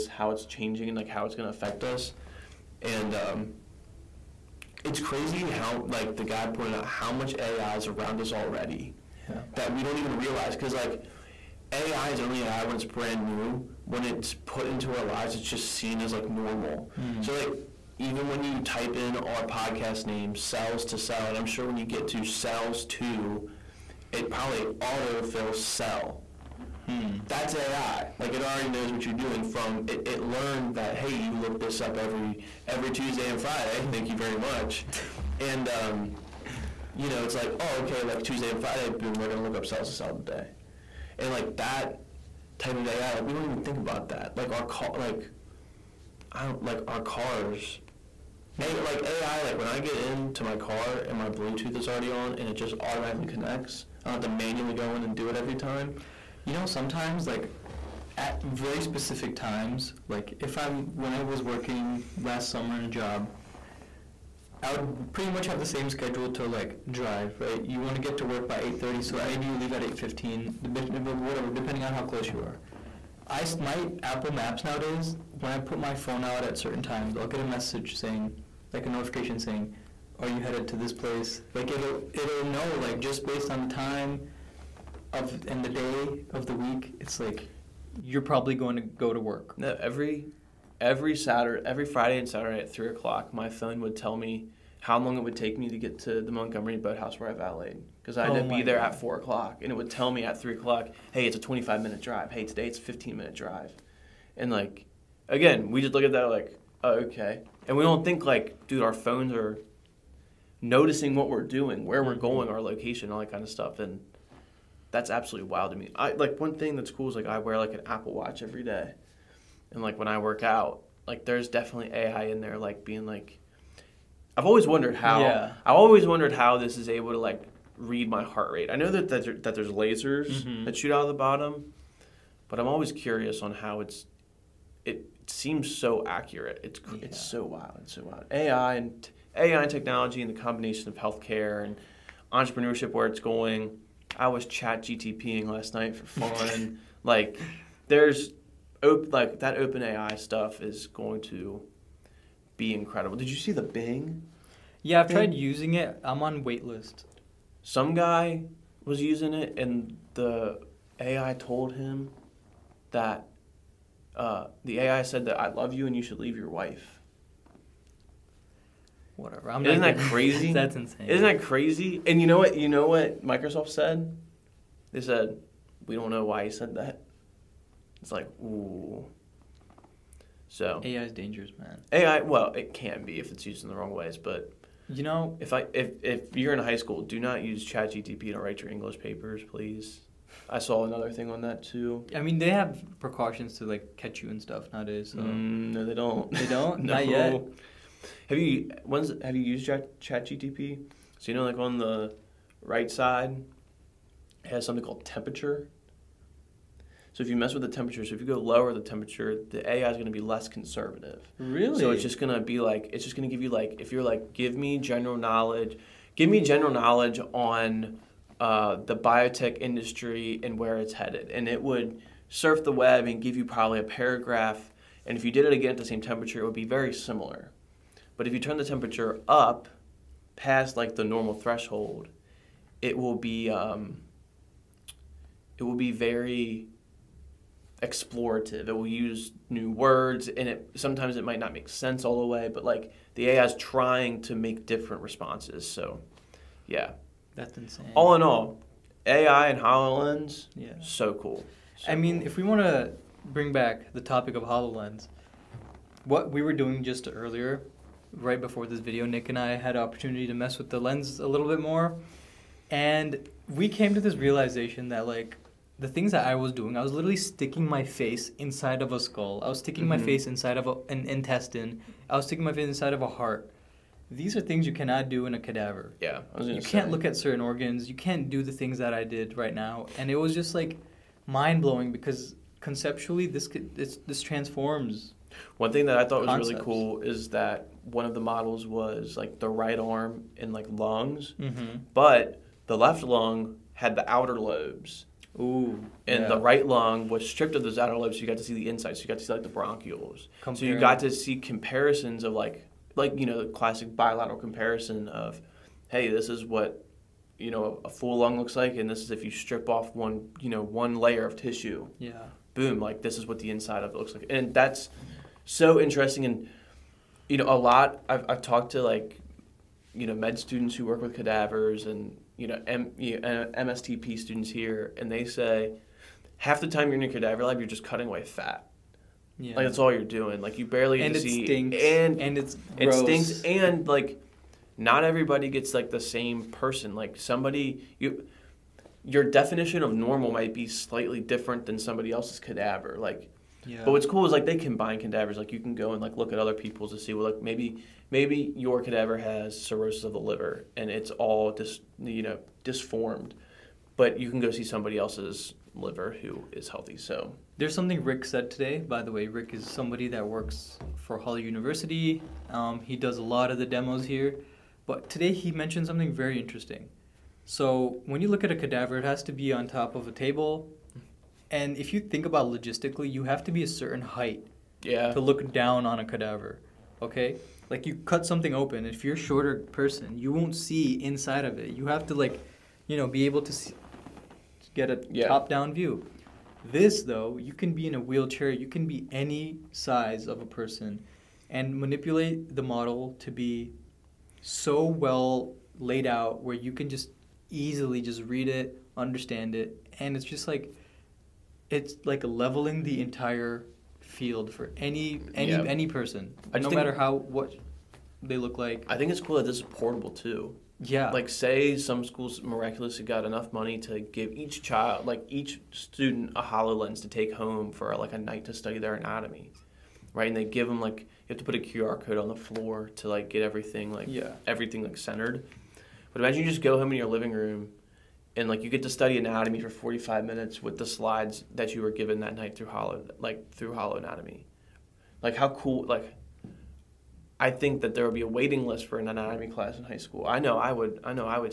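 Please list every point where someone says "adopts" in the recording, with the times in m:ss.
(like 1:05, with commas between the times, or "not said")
not said.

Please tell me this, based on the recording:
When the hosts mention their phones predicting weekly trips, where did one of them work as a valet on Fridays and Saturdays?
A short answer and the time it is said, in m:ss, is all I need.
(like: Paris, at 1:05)
Montgomery Boathouse, at 1:36.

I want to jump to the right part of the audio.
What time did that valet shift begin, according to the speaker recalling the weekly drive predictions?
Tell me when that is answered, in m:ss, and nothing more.
1:39.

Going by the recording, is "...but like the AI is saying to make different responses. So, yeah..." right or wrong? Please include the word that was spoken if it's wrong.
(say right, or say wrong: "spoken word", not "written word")
wrong: "trying", not "saying".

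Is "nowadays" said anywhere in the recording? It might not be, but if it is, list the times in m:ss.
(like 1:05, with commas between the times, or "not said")
1:14, 3:14.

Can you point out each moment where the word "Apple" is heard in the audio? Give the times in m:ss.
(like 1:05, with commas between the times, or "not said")
1:14, 1:57.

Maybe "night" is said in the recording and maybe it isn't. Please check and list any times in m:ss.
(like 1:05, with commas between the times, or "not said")
2:25, 6:58, 7:12.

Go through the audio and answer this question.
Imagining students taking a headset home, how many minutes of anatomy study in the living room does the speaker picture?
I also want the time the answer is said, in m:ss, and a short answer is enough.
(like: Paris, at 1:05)
45, at 7:09.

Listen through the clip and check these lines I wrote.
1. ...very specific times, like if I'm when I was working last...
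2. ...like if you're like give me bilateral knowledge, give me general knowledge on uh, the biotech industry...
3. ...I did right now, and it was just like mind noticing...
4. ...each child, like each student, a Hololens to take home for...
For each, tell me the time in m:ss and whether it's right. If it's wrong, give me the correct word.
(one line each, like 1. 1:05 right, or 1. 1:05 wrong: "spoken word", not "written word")
1. 0:58 right
2. 3:33 wrong: "general", not "bilateral"
3. 4:38 wrong: "blowing", not "noticing"
4. 6:54 right.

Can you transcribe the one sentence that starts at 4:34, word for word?
These are things you cannot do in a cadaver.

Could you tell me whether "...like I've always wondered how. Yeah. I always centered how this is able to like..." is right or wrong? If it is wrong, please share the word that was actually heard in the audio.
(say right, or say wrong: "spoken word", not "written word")
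wrong: "wondered", not "centered".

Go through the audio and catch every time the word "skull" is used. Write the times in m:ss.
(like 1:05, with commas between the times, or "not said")
4:29.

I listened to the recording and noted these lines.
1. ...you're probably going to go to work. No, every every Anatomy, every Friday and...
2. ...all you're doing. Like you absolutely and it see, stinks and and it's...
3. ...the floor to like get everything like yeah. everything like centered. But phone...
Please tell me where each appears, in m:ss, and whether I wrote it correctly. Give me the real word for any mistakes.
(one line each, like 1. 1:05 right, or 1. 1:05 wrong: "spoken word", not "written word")
1. 1:28 wrong: "Saturday", not "Anatomy"
2. 5:29 wrong: "barely", not "absolutely"
3. 7:02 wrong: "imagine", not "phone".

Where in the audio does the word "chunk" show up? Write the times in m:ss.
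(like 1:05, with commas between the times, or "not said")
not said.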